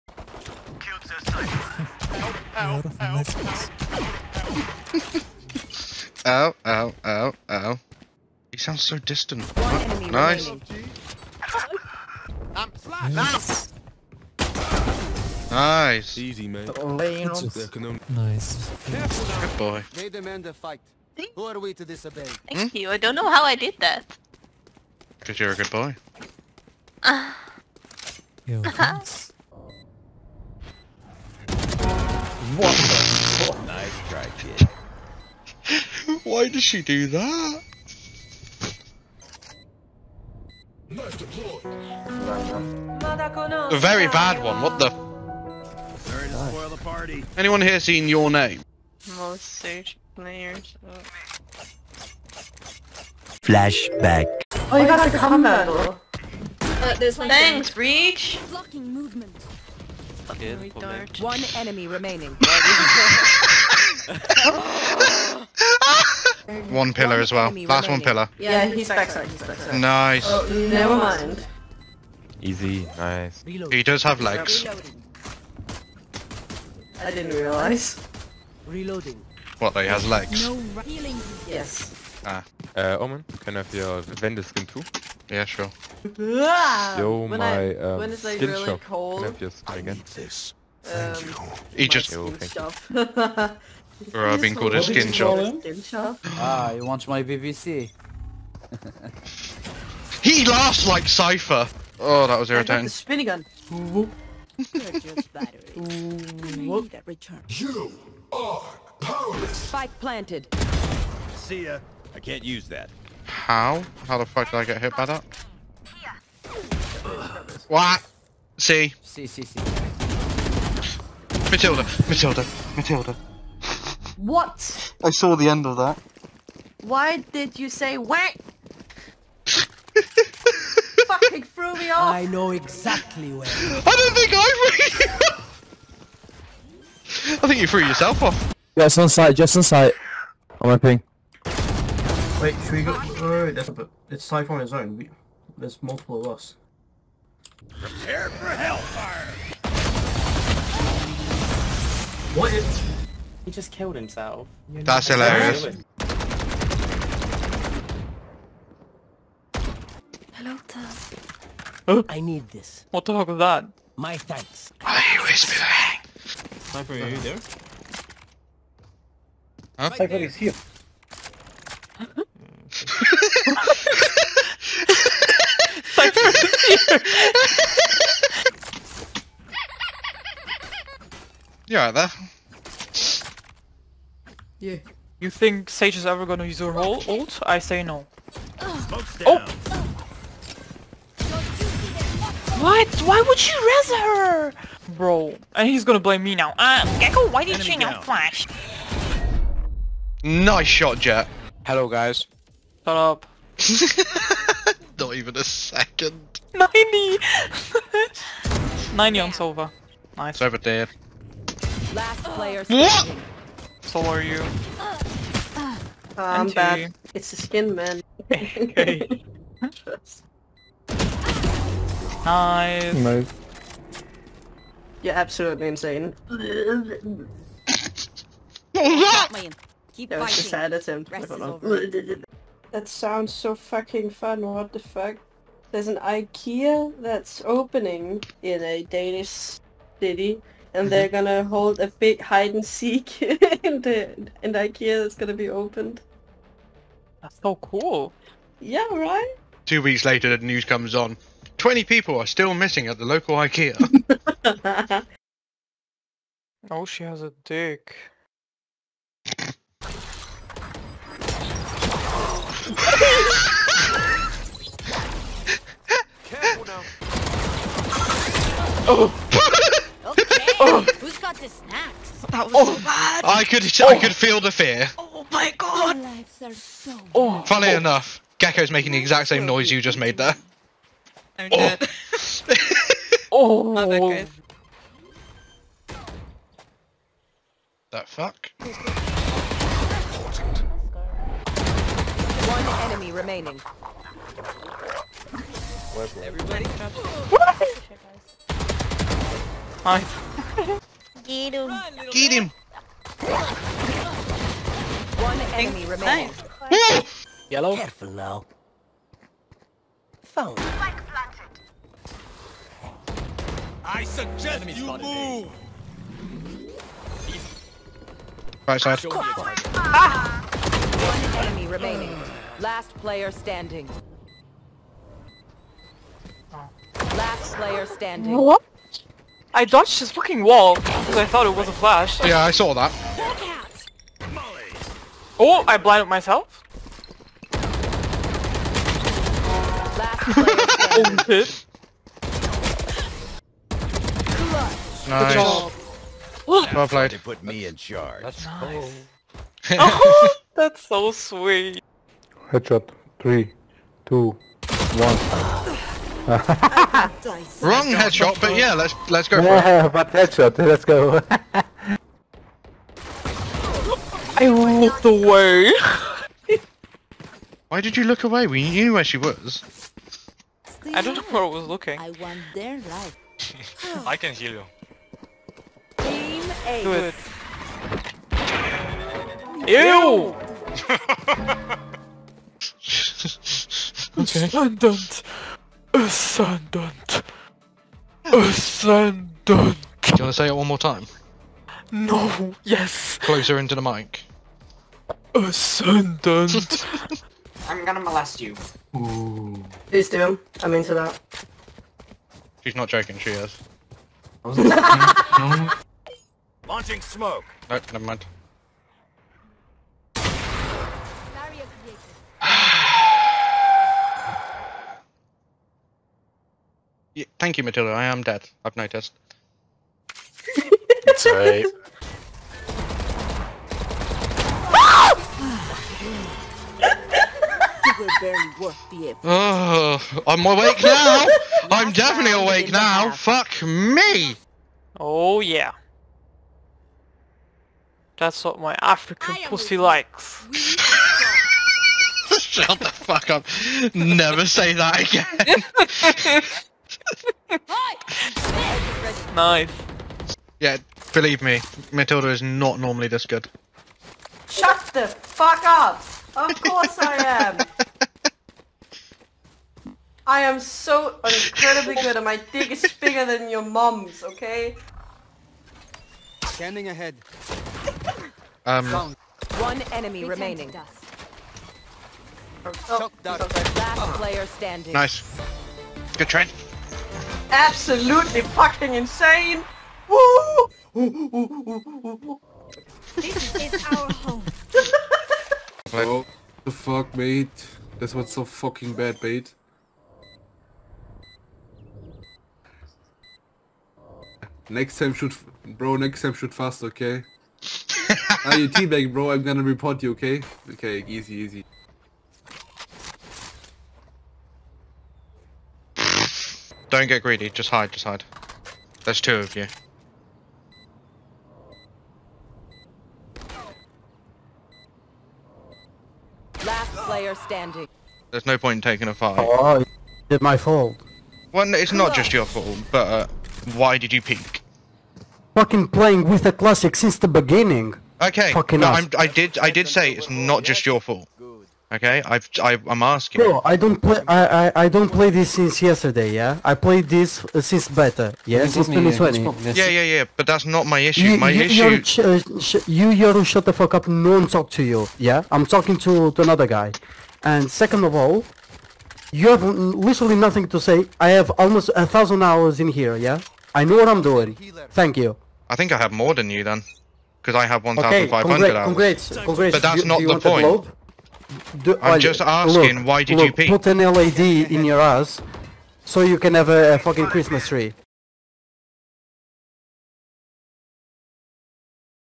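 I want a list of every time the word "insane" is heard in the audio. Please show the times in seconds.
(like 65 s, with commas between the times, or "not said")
225 s, 478 s.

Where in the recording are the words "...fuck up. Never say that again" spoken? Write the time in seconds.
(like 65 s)
442 s.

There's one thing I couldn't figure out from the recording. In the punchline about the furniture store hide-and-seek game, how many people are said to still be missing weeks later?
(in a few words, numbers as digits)
20.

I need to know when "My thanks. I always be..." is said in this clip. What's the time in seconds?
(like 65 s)
163 s.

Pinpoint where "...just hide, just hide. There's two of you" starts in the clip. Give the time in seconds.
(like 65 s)
507 s.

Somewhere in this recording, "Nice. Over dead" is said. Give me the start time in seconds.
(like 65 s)
210 s.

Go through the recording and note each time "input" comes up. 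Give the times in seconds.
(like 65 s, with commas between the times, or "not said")
not said.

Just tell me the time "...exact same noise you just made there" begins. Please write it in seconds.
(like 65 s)
278 s.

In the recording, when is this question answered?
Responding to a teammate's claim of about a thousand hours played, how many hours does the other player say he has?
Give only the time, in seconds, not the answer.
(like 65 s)
557 s.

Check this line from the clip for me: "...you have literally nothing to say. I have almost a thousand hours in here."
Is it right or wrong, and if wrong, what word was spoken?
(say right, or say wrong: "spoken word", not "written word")
right.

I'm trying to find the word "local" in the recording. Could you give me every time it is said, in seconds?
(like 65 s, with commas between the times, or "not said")
253 s.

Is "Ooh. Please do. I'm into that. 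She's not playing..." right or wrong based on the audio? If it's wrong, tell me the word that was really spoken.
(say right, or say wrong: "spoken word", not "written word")
wrong: "joking", not "playing".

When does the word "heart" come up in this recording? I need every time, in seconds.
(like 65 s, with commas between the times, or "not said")
not said.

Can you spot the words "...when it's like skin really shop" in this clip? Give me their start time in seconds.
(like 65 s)
87 s.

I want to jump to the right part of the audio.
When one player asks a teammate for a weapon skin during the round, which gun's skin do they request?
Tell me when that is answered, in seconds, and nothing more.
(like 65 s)
84 s.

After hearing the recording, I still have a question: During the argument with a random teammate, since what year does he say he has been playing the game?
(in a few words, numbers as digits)
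2020.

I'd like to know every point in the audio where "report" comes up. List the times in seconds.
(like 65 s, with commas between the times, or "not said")
499 s.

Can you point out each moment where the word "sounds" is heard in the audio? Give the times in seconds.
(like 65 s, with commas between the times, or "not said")
8 s, 232 s.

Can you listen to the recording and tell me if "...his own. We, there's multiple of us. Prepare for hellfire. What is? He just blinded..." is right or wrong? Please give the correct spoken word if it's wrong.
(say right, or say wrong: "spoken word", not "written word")
wrong: "killed", not "blinded".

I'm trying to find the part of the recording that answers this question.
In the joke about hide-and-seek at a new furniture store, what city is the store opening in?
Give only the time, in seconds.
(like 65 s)
238 s.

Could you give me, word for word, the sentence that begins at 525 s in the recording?
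Fucking playing with the classic since the beginning.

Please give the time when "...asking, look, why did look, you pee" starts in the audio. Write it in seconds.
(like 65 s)
562 s.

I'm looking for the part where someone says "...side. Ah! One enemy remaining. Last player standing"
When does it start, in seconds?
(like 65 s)
318 s.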